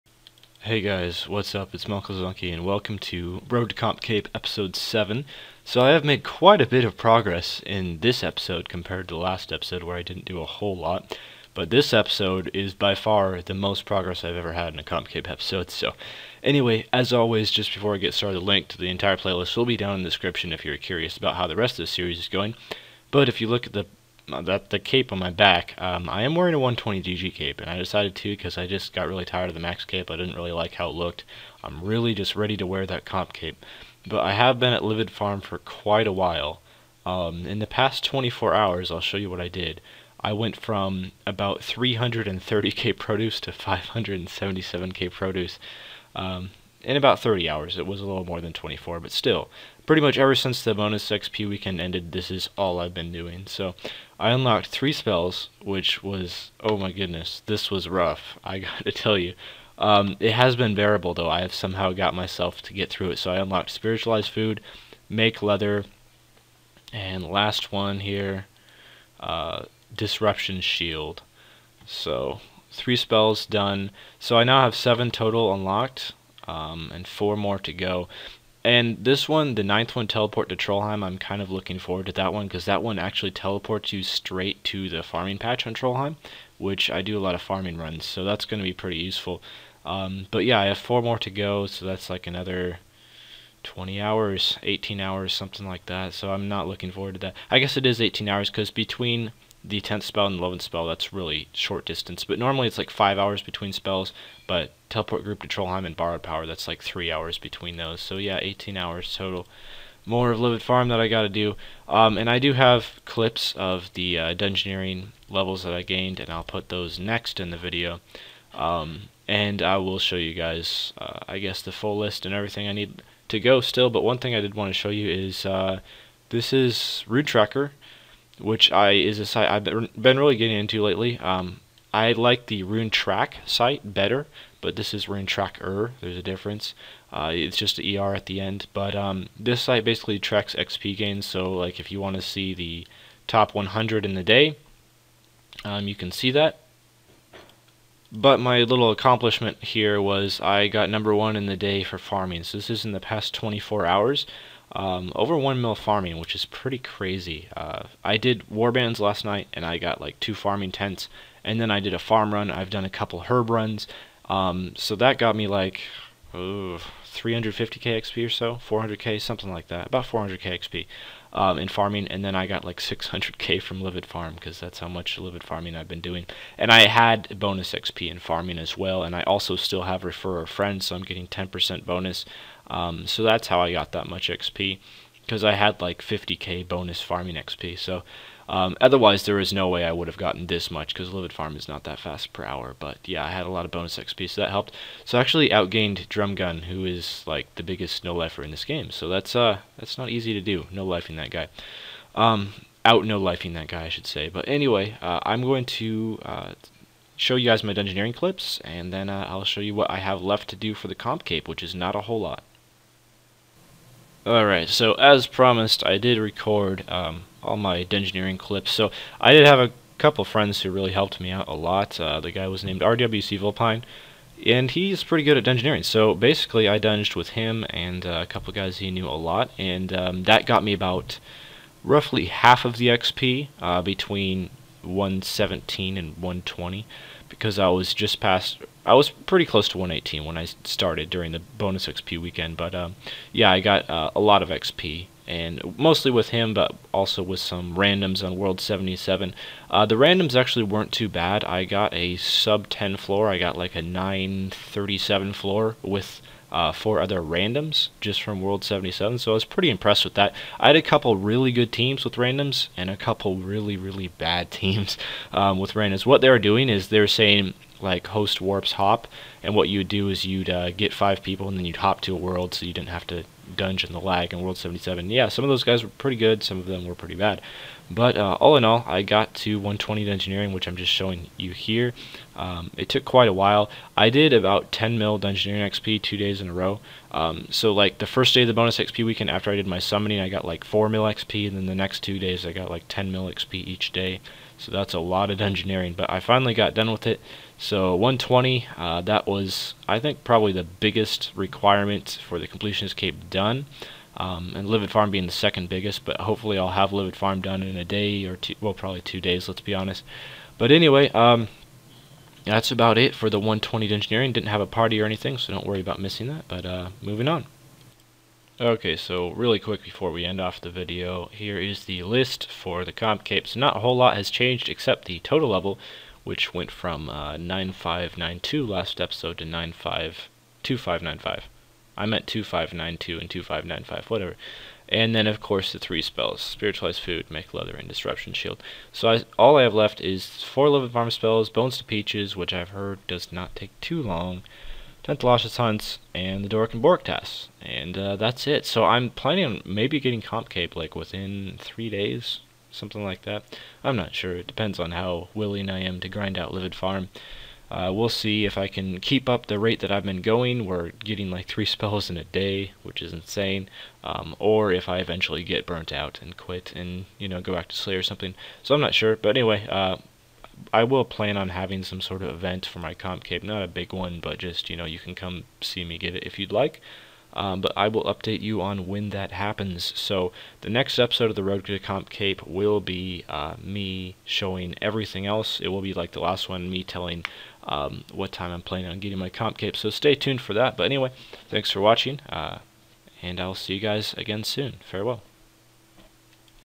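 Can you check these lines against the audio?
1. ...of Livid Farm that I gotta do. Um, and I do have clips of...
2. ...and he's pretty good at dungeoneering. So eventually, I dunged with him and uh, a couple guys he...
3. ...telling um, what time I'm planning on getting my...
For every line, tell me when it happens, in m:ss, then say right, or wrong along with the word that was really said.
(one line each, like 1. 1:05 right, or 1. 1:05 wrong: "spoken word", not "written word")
1. 1:50 right
2. 3:44 wrong: "basically", not "eventually"
3. 6:26 right.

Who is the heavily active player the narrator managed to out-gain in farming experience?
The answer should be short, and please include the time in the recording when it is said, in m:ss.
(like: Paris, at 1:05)
Drumgun, at 3:16.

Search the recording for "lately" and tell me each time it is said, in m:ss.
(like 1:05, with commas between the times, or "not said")
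2:10.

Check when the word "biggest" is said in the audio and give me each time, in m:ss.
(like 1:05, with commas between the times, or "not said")
3:17, 5:00, 5:05.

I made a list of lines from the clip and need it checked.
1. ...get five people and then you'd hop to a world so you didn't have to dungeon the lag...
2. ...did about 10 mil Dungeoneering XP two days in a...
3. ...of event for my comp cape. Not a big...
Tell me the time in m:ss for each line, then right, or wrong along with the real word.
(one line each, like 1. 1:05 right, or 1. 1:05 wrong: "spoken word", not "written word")
1. 4:30 right
2. 4:44 right
3. 6:12 right.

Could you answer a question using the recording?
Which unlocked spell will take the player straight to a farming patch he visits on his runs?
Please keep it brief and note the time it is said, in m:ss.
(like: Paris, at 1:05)
Teleport to Trollheim, at 1:20.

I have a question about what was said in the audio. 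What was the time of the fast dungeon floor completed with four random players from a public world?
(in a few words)
937.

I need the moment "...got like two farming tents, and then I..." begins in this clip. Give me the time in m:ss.
2:39.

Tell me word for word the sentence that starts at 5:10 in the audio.
But anyway, um, that's about it for the 120 Dungeoneering.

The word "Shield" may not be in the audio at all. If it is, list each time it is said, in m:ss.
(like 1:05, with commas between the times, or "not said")
1:10, 5:38.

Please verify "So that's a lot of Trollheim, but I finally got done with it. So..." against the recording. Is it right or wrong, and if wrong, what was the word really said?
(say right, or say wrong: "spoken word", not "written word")
wrong: "Dungeoneering", not "Trollheim".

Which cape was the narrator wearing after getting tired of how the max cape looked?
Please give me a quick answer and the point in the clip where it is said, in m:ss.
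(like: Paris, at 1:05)
120 DG cape, at 0:26.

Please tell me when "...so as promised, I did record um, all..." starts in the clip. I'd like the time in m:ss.
3:34.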